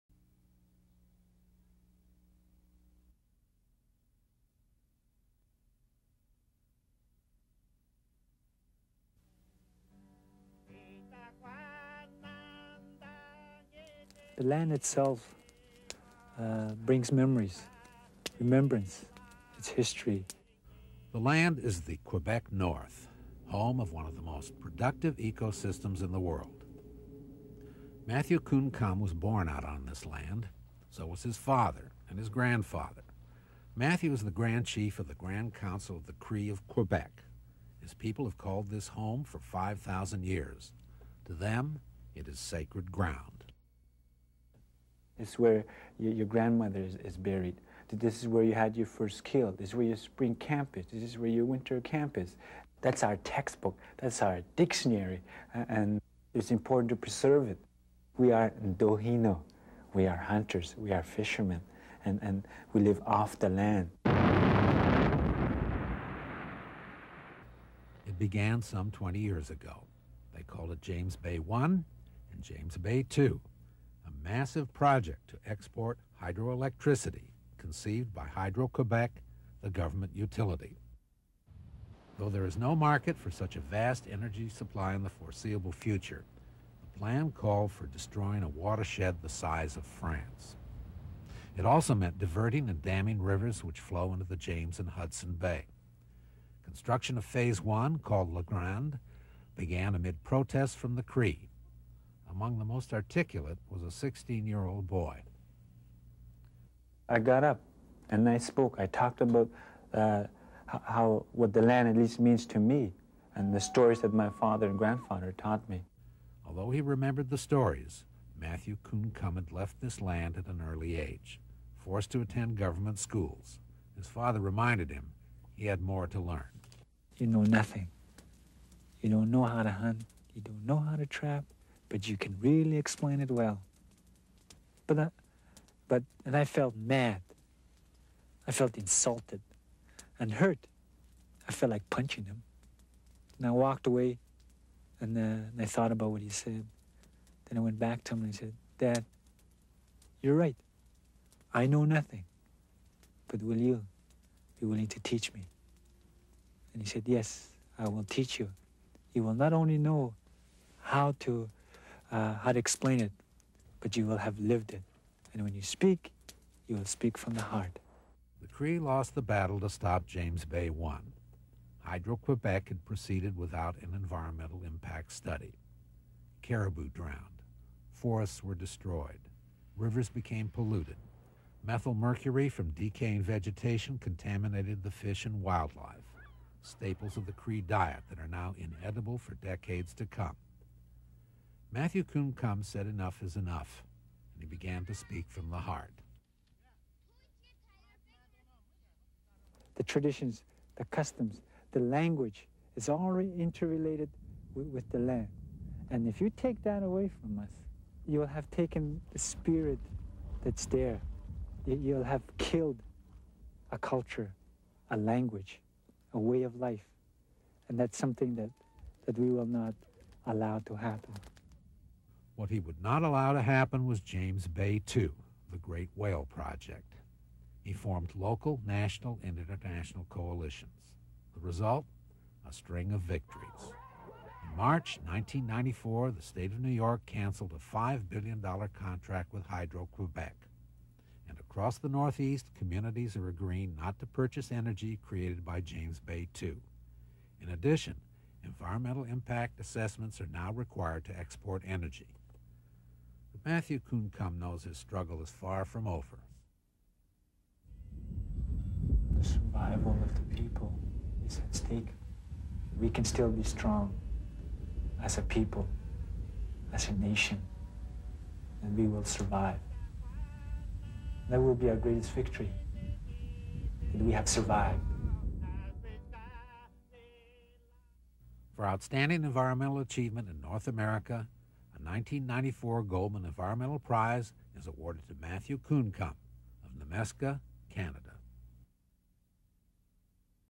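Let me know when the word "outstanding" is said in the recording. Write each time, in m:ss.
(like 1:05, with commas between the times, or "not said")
4:38.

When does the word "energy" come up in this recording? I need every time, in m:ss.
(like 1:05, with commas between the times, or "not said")
1:24, 4:04, 4:11.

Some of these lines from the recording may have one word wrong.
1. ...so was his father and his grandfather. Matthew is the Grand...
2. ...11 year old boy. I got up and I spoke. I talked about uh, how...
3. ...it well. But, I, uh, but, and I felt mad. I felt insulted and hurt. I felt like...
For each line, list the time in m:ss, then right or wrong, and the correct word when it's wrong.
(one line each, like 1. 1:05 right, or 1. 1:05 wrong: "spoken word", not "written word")
1. 0:30 right
2. 1:43 wrong: "16", not "11"
3. 2:13 right.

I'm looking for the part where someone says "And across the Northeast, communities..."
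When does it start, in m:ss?
4:01.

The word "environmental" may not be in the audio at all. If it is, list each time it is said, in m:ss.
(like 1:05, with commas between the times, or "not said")
2:53, 4:08, 4:39, 4:43.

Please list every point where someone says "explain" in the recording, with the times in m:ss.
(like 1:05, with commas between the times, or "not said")
2:12, 2:42.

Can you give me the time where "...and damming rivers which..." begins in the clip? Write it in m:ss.
1:32.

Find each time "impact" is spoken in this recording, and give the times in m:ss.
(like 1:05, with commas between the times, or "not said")
2:54, 4:09.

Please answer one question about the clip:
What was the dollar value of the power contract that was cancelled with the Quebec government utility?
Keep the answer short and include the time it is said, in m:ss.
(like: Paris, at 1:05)
$5 billion, at 3:57.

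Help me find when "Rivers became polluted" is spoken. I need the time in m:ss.
2:59.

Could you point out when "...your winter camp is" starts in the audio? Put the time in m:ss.
0:51.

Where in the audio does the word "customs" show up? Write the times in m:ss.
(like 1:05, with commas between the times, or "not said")
3:20.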